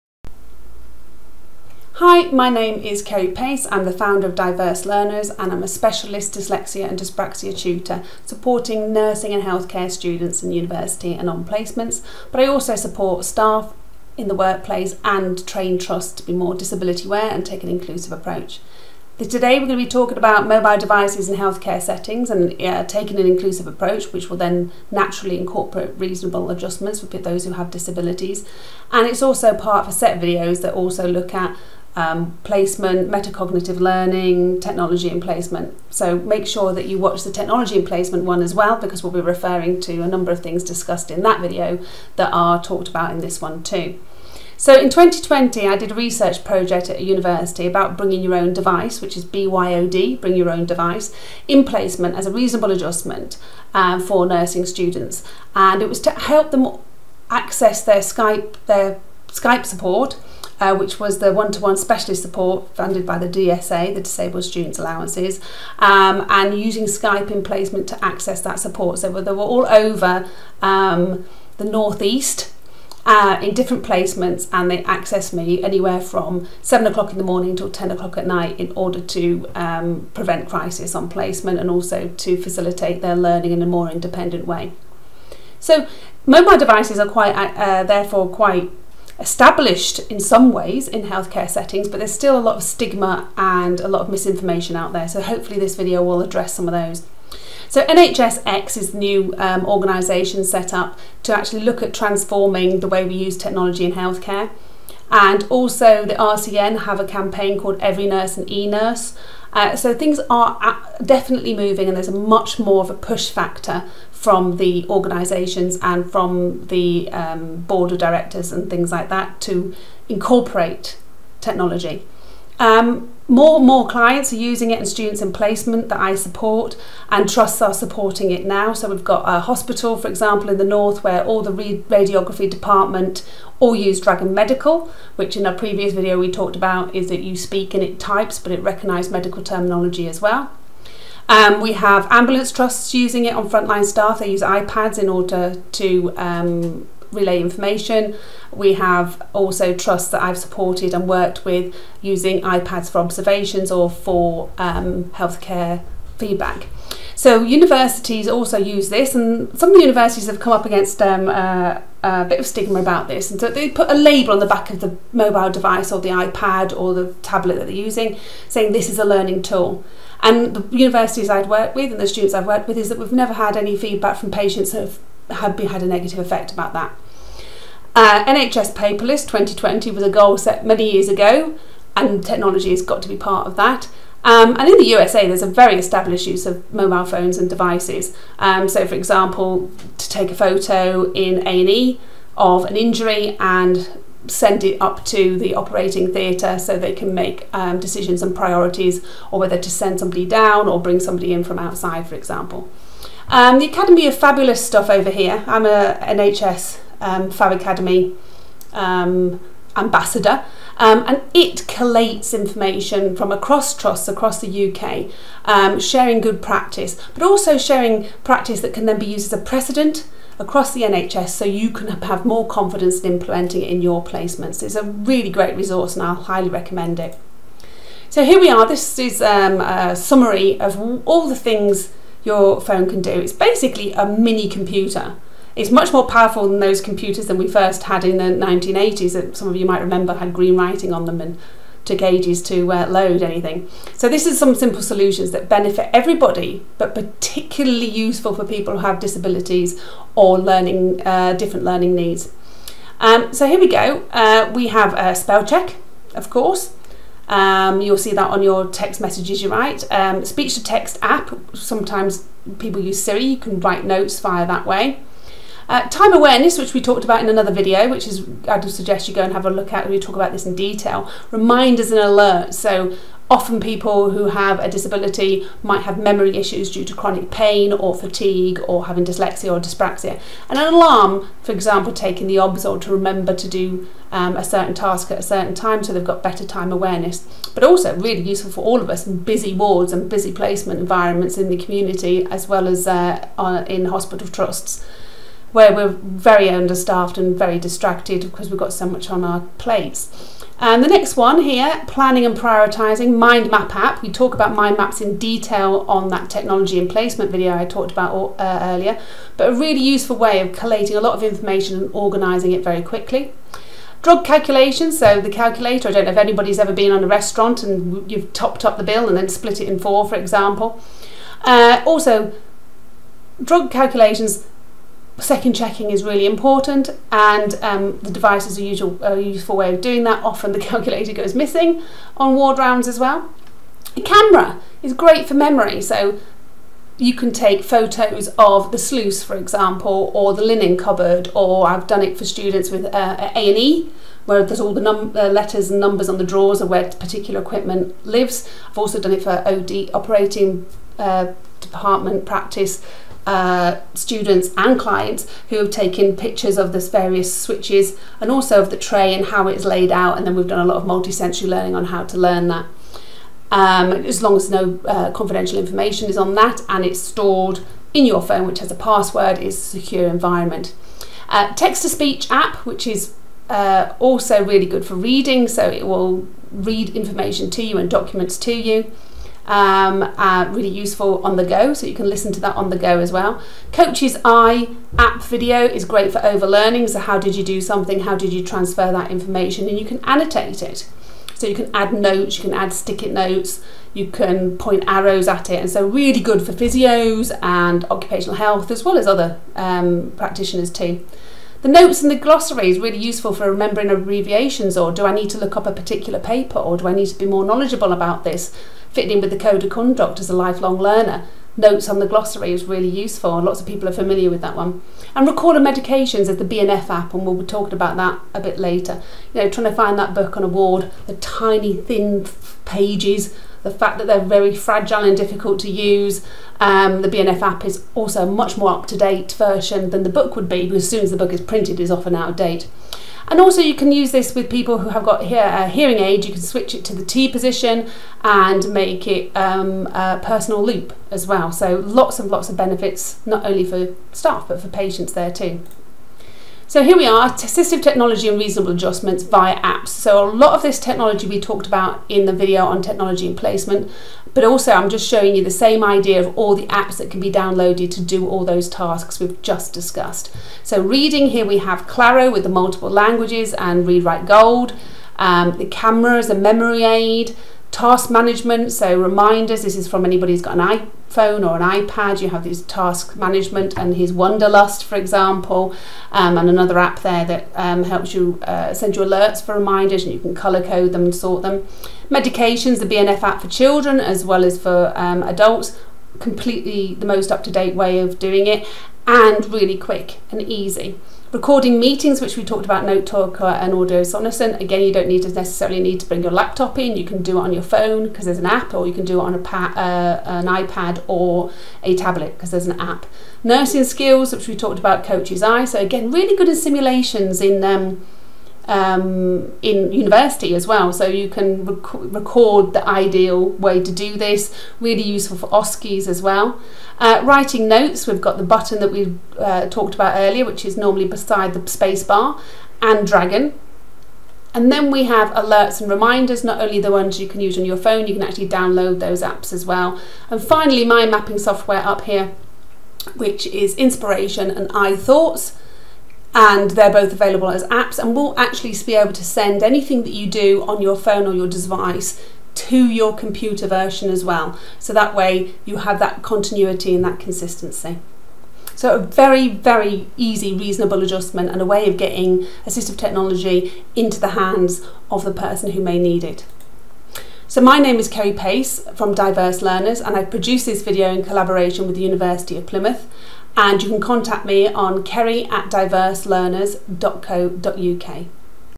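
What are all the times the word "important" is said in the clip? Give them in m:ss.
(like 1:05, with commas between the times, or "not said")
5:26.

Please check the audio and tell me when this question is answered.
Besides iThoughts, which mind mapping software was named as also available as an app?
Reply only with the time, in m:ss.
8:53.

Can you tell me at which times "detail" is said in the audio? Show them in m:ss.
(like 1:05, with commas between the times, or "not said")
4:30, 5:05.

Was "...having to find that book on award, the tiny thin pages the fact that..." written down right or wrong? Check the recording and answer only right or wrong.
wrong.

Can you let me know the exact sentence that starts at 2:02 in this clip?
Um, more and more clients are using it and students in placement that I support and trusts are supporting it now.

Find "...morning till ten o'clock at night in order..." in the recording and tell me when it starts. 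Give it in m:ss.
1:17.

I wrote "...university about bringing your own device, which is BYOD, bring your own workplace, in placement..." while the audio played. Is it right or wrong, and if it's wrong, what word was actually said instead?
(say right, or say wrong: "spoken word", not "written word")
wrong: "device", not "workplace".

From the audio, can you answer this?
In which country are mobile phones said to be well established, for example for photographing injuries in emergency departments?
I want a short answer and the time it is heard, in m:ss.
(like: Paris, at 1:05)
USA, at 3:04.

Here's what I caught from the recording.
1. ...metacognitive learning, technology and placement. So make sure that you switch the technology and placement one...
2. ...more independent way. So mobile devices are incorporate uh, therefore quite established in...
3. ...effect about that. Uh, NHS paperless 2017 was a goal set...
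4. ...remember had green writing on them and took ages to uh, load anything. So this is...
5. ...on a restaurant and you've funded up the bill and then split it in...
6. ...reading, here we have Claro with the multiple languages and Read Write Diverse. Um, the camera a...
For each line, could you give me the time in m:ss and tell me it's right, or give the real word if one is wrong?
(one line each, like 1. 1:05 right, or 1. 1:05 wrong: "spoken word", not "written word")
1. 0:33 wrong: "watch", not "switch"
2. 1:23 wrong: "quite", not "incorporate"
3. 2:56 wrong: "2020", not "2017"
4. 3:59 right
5. 5:16 wrong: "topped", not "funded"
6. 7:40 wrong: "Gold", not "Diverse".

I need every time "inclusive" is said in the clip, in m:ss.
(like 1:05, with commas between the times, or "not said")
0:17, 0:23.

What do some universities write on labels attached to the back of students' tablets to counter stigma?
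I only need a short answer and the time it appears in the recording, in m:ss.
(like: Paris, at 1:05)
This is a learning tool, at 2:48.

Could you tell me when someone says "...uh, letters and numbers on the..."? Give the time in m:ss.
5:44.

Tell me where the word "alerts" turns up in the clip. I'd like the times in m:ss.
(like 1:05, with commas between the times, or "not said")
4:32, 7:59, 8:45.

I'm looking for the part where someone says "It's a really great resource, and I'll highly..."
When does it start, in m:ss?
3:44.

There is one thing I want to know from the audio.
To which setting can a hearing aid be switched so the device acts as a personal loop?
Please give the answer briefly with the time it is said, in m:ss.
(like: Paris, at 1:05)
T position, at 7:16.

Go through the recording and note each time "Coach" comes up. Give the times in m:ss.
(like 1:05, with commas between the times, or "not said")
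6:23, 8:25.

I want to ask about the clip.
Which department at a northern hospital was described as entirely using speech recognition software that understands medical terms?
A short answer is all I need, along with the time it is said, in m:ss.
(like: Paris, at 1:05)
Radiography, at 2:11.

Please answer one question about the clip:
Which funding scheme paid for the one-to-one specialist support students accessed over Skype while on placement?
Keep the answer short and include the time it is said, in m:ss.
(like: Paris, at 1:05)
Disabled Students Allowances, at 1:03.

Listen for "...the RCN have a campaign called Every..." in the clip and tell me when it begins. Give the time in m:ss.
1:46.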